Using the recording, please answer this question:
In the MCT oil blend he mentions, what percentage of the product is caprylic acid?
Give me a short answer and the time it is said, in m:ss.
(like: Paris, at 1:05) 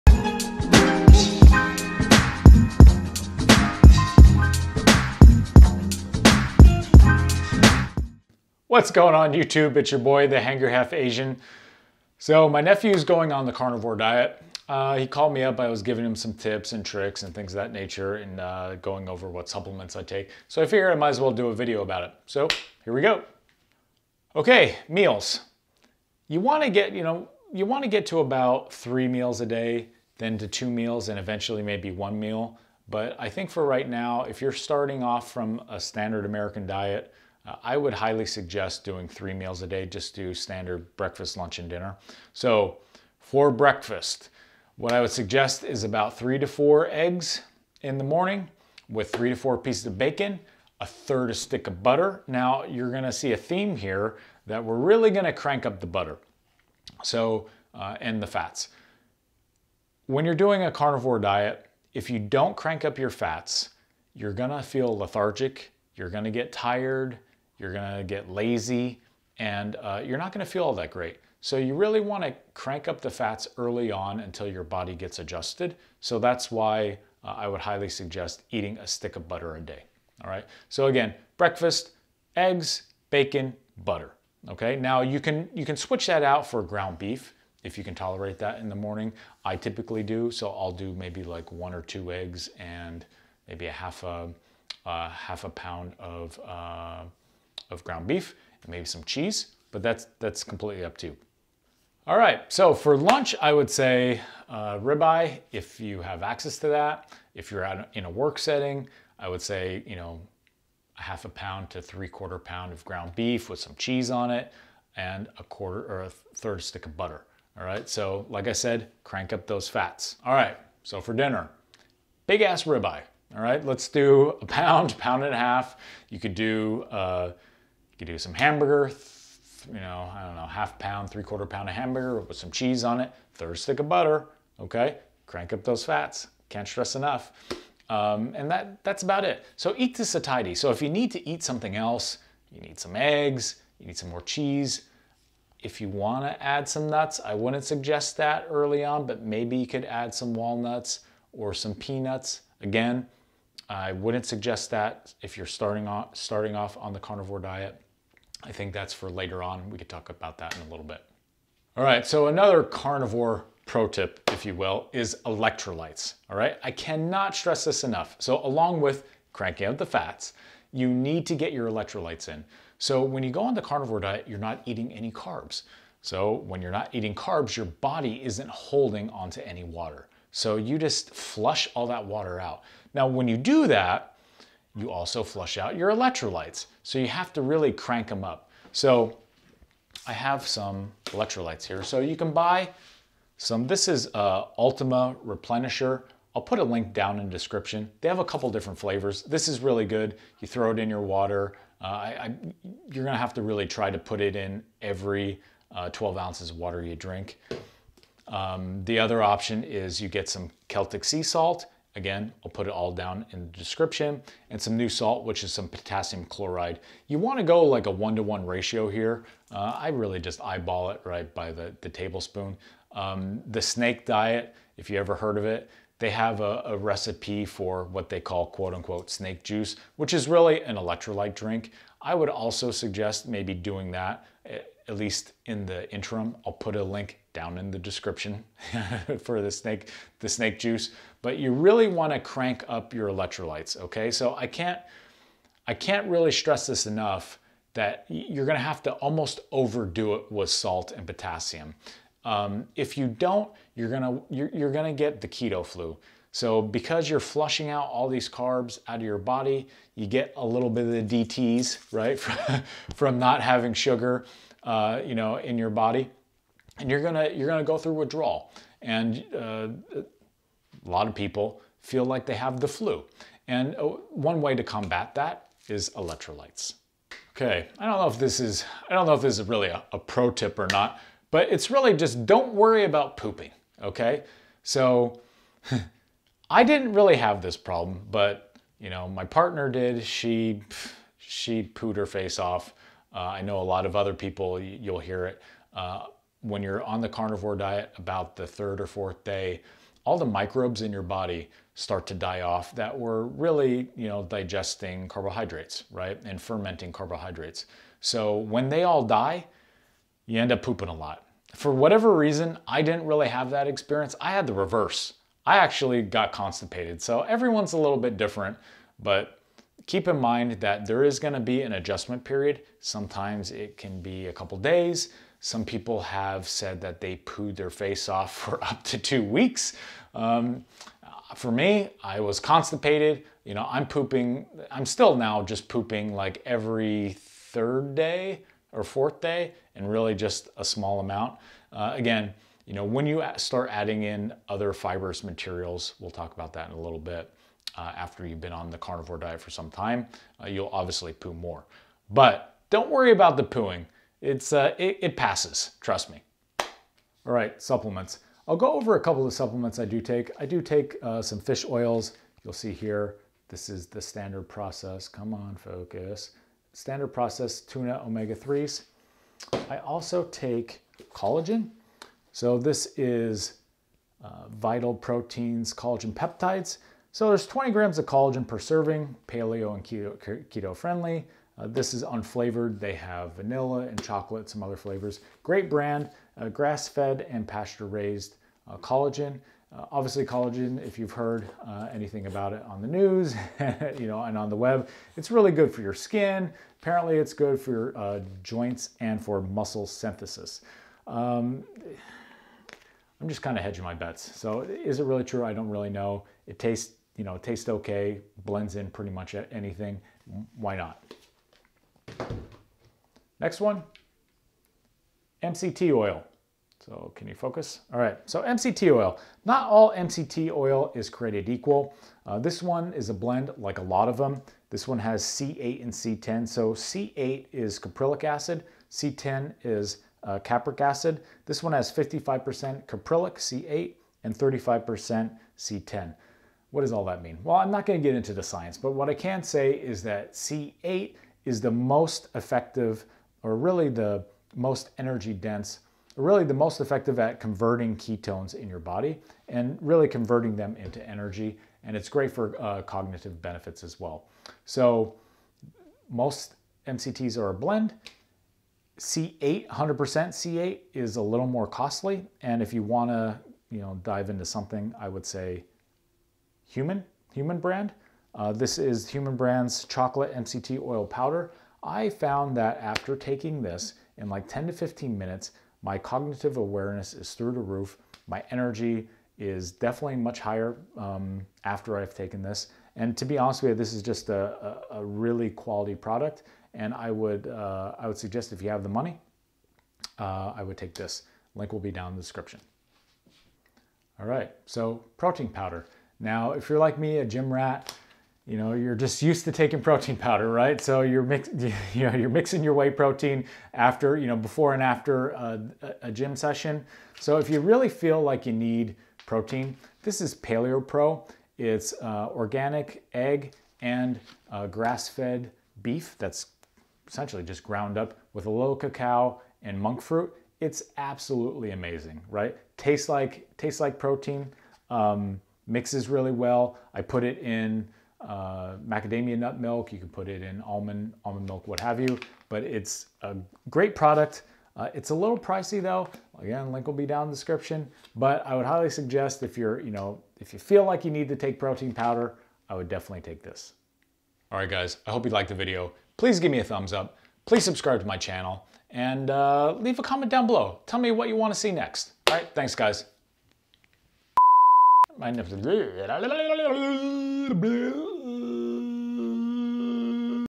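55%, at 7:11.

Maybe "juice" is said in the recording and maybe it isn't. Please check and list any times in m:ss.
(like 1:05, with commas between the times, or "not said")
3:49, 4:00.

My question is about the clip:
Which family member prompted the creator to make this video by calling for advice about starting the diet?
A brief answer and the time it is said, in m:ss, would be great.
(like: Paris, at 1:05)
nephew, at 0:12.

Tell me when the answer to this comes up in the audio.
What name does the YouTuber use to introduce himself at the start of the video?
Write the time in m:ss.
0:10.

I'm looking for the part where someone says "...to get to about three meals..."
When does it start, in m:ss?
0:27.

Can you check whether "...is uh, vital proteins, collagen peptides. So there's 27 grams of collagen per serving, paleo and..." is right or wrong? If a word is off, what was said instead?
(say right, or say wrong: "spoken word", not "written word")
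wrong: "20", not "27".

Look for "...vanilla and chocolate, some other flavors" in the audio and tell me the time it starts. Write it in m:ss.
6:23.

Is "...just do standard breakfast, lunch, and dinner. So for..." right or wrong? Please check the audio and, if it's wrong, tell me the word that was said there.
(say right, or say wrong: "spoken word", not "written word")
right.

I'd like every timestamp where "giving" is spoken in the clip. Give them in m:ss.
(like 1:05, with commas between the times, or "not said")
0:15.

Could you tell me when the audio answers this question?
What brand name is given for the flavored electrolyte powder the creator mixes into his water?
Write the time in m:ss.
3:14.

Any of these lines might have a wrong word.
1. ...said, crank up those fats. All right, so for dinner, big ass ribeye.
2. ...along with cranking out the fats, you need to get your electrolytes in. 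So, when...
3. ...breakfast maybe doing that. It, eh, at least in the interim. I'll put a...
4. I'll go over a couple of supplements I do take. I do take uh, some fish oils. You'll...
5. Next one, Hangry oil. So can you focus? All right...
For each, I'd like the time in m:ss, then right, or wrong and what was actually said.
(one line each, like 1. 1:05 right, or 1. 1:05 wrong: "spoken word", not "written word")
1. 1:58 right
2. 2:48 right
3. 3:52 wrong: "suggest", not "breakfast"
4. 5:58 right
5. 6:53 wrong: "MCT", not "Hangry".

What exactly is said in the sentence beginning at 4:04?
So I can't, I can't really stress this enough that you're going to have to almost overdo it with salt and potassium.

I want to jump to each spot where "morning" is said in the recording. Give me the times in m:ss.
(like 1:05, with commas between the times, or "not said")
0:48, 1:28.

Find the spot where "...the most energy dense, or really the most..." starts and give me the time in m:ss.
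7:23.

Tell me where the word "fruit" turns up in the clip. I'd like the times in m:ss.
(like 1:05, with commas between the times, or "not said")
8:40.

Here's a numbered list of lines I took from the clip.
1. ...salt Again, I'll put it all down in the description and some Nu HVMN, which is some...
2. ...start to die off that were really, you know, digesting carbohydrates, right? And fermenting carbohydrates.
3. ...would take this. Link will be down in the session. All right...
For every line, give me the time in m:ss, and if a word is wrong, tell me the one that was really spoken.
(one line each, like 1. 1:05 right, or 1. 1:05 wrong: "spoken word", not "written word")
1. 3:31 wrong: "Salt", not "HVMN"
2. 5:01 right
3. 8:10 wrong: "description", not "session".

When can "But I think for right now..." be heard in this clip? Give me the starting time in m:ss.
0:32.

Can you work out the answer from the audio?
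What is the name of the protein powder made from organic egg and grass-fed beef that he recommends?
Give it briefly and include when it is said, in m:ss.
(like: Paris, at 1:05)
Paleo Pro, at 8:30.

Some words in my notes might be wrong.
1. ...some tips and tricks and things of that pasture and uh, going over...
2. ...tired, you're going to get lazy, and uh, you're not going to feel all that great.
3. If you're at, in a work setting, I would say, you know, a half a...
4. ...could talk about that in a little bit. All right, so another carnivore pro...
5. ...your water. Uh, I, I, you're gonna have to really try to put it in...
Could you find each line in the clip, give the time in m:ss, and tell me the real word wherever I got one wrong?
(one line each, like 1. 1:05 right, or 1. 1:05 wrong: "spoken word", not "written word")
1. 0:16 wrong: "nature", not "pasture"
2. 1:06 right
3. 1:47 right
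4. 2:39 right
5. 3:20 right.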